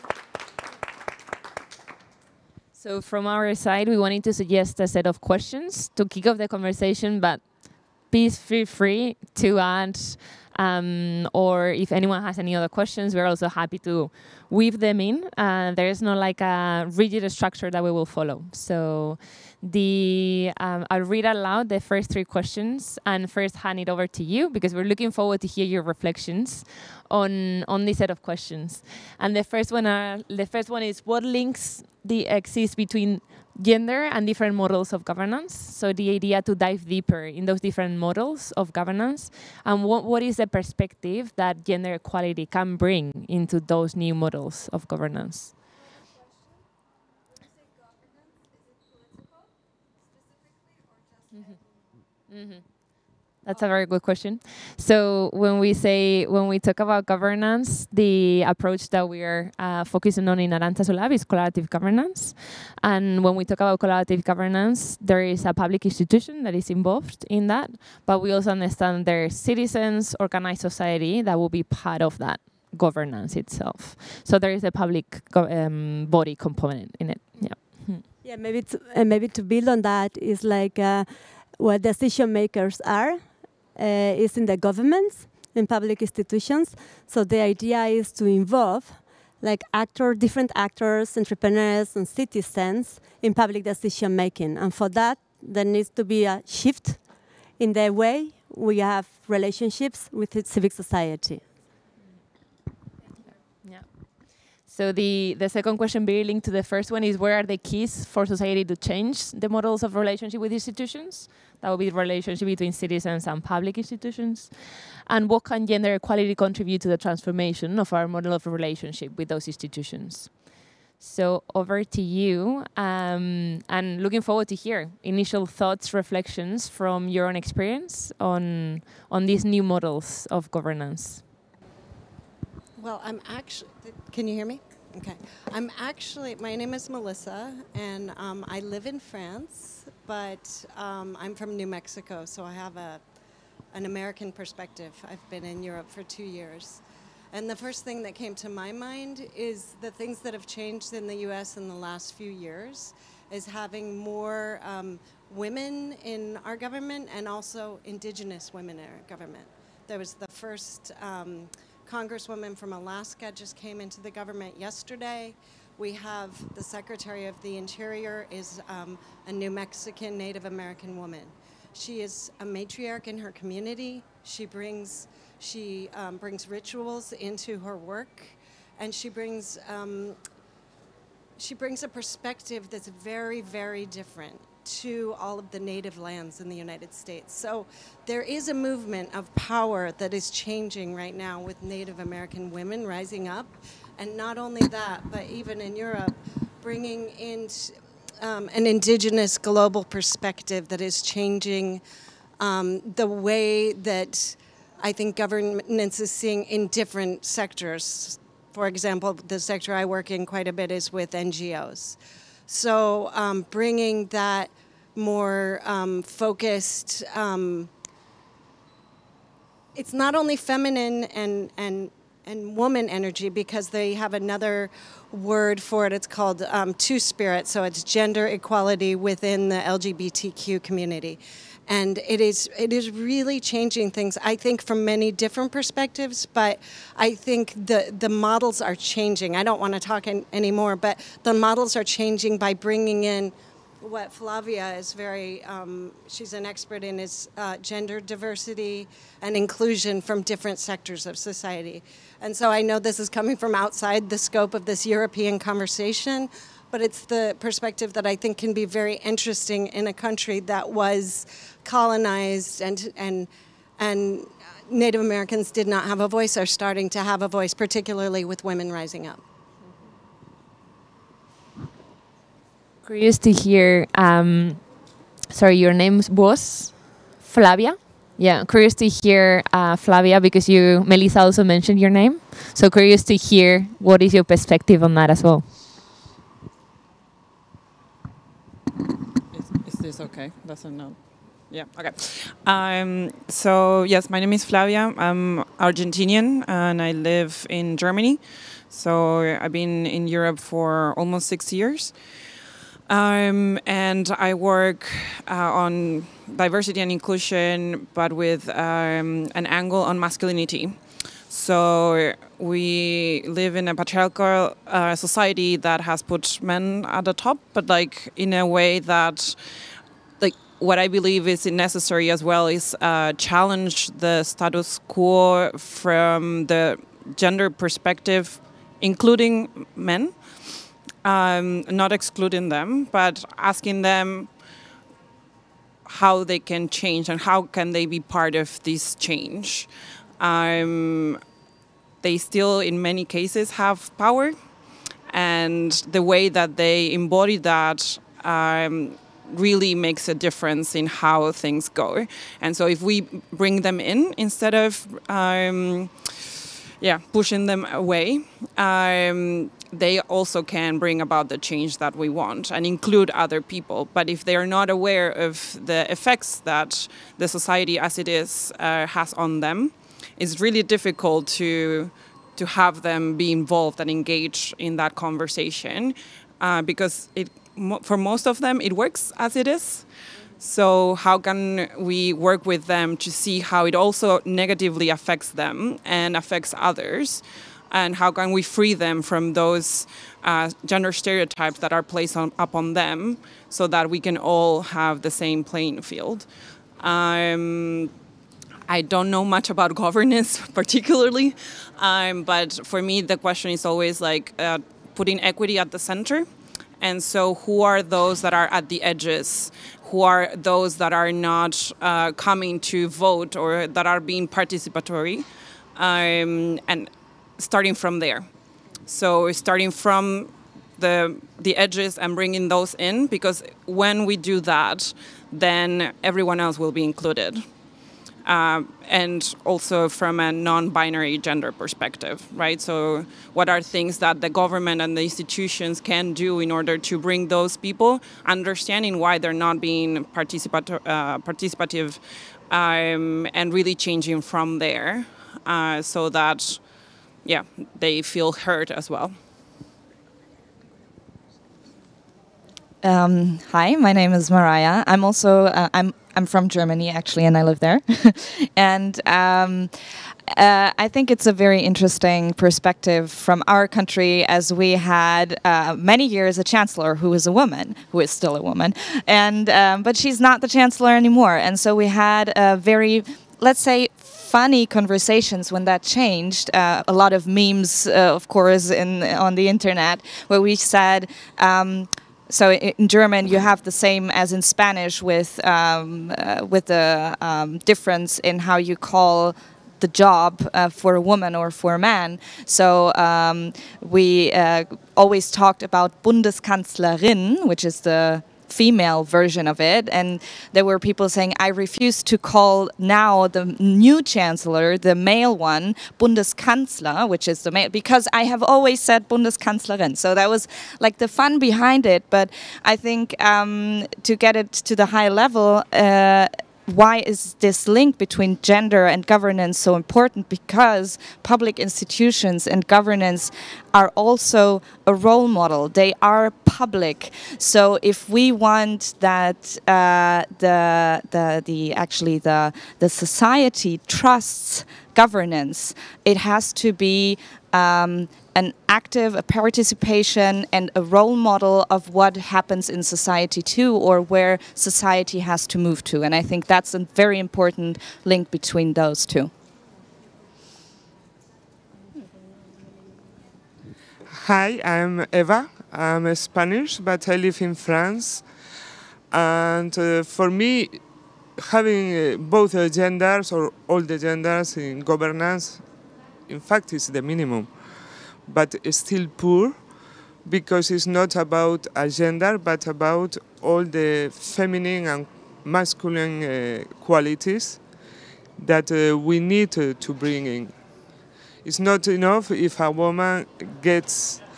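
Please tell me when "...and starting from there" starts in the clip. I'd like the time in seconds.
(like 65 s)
416 s.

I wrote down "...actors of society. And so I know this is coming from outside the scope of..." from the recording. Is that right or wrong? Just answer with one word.
wrong.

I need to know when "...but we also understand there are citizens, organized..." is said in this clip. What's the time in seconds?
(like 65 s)
68 s.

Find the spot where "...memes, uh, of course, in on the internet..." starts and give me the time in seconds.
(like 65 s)
477 s.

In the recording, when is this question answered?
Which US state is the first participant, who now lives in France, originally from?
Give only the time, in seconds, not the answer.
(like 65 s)
141 s.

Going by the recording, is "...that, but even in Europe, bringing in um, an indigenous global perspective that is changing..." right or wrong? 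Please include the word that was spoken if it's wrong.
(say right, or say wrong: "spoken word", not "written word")
right.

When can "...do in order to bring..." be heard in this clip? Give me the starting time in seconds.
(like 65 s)
436 s.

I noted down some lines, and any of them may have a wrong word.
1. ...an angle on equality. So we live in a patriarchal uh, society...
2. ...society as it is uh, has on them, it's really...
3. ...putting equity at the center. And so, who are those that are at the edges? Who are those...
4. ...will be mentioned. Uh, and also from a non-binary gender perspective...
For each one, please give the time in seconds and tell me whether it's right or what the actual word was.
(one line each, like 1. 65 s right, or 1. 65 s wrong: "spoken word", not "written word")
1. 309 s wrong: "masculinity", not "equality"
2. 367 s right
3. 404 s right
4. 426 s wrong: "included", not "mentioned".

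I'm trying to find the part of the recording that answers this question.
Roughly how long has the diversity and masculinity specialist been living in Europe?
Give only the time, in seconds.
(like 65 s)
300 s.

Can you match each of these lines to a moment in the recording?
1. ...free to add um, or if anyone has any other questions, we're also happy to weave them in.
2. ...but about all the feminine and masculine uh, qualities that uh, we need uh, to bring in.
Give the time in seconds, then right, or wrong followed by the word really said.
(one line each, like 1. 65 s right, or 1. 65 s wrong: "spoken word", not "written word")
1. 8 s right
2. 572 s right.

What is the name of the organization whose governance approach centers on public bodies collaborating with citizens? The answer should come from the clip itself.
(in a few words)
Arantzazulab.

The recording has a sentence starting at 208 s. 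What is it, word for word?
For example, the sector I work in quite a bit is with NGOs.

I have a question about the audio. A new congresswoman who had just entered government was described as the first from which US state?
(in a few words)
Alaska.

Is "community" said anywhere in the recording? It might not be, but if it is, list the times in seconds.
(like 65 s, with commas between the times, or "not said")
173 s, 230 s.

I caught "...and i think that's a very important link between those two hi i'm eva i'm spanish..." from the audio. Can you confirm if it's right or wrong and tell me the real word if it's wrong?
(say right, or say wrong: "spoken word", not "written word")
right.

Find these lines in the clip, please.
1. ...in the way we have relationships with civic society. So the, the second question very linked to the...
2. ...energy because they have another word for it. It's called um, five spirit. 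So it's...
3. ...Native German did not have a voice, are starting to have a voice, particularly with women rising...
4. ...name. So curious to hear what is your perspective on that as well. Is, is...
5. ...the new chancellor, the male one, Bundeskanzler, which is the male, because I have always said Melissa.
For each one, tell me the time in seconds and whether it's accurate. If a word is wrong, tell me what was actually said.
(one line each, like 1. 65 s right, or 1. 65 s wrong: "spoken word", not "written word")
1. 97 s right
2. 222 s wrong: "two", not "five"
3. 264 s wrong: "Americans", not "German"
4. 281 s right
5. 503 s wrong: "Bundeskanzlerin", not "Melissa".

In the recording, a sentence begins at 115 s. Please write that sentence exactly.
And what can gender equality contribute to the transformation of our model of relationship with those institutions?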